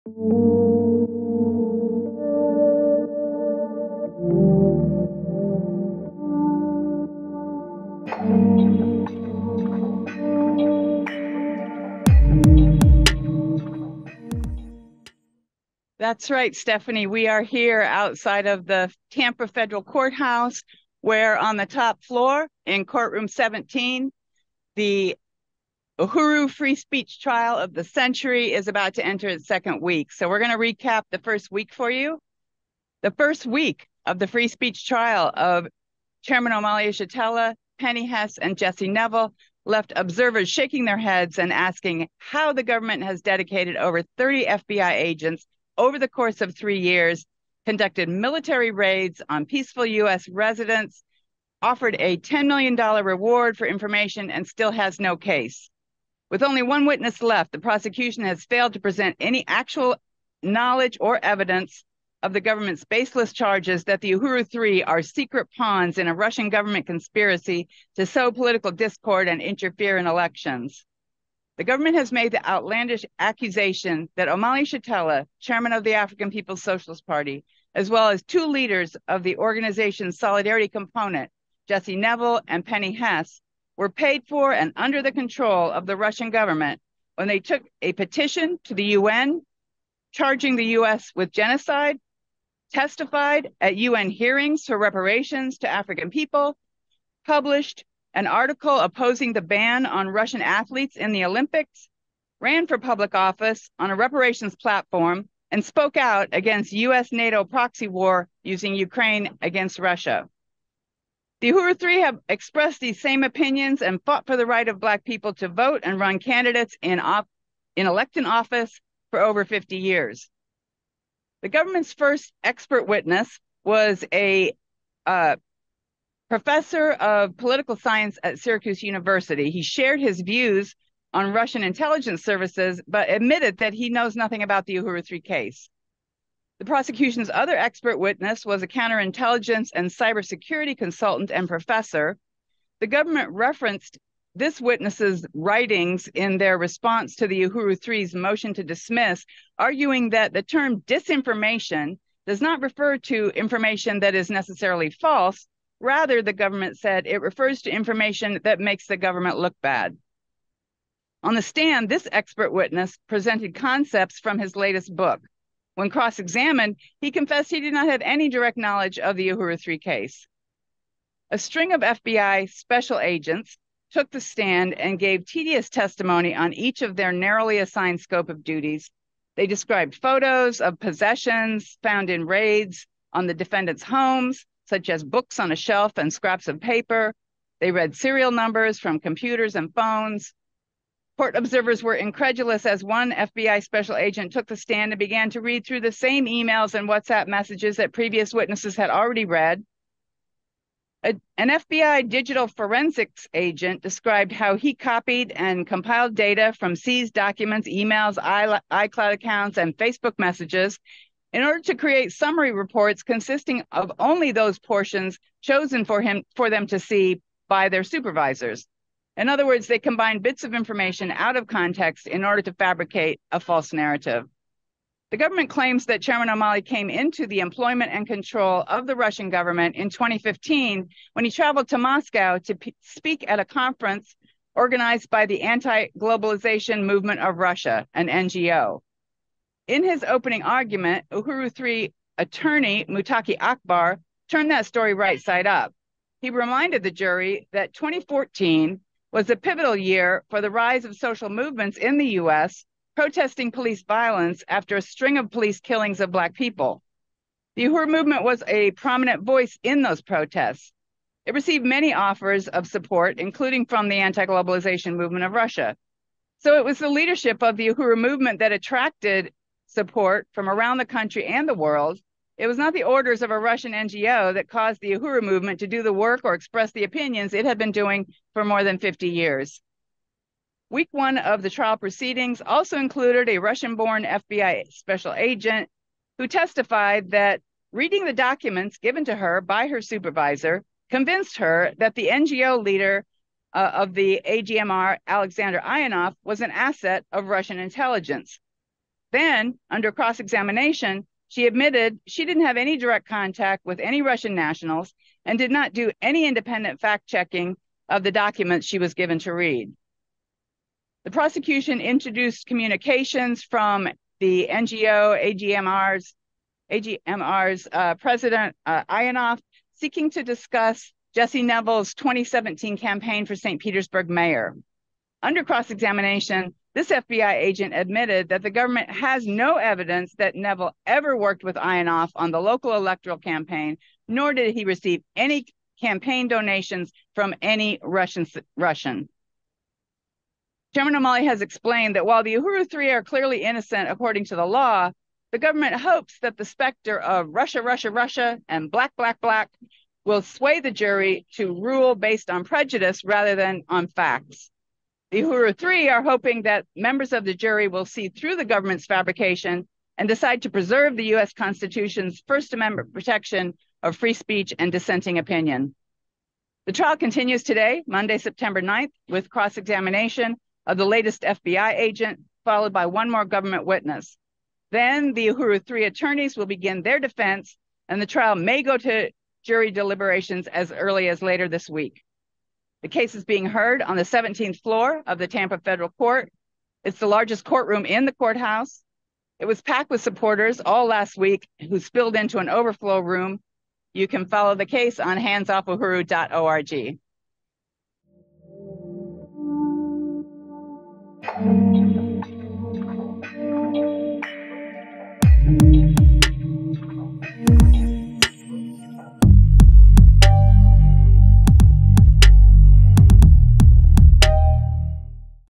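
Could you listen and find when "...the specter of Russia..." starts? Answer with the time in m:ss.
5:46.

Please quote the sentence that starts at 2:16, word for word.
The prosecution's other expert witness was a counterintelligence and cybersecurity consultant and professor.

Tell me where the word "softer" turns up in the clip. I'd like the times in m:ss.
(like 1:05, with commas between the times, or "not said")
not said.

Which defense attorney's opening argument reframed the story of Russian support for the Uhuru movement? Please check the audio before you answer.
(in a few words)
Mutaqee Akbar.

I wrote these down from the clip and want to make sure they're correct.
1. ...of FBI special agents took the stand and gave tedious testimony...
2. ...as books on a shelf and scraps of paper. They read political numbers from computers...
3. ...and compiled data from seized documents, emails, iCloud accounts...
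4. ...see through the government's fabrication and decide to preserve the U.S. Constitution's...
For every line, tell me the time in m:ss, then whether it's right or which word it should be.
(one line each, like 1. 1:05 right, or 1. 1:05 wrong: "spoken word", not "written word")
1. 2:51 right
2. 3:04 wrong: "serial", not "political"
3. 3:25 right
4. 5:57 right.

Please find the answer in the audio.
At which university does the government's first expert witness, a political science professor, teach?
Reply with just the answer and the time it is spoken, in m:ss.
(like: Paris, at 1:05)
Syracuse University, at 2:08.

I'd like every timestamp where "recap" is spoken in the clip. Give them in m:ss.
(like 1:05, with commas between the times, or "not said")
0:30.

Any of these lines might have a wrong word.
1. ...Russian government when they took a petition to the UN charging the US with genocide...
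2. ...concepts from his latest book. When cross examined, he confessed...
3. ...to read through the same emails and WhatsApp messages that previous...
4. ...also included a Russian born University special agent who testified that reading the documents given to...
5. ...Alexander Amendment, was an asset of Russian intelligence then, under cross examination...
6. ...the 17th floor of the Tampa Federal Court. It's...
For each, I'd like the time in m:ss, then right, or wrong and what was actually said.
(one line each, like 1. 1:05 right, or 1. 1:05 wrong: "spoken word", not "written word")
1. 1:25 right
2. 2:43 right
3. 3:15 right
4. 4:42 wrong: "FBI", not "University"
5. 4:55 wrong: "Ionov", not "Amendment"
6. 6:23 right.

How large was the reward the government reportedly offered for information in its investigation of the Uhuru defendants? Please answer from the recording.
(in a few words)
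$10 million.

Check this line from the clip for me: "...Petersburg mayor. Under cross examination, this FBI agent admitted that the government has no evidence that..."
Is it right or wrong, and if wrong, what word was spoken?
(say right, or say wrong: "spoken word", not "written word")
right.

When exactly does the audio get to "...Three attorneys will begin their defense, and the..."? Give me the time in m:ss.
6:15.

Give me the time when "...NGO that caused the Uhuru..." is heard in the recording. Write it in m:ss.
4:33.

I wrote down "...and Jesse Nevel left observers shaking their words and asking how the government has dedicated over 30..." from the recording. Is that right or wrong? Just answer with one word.
wrong.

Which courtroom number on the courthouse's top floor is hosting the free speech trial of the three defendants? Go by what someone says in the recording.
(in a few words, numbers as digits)
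17.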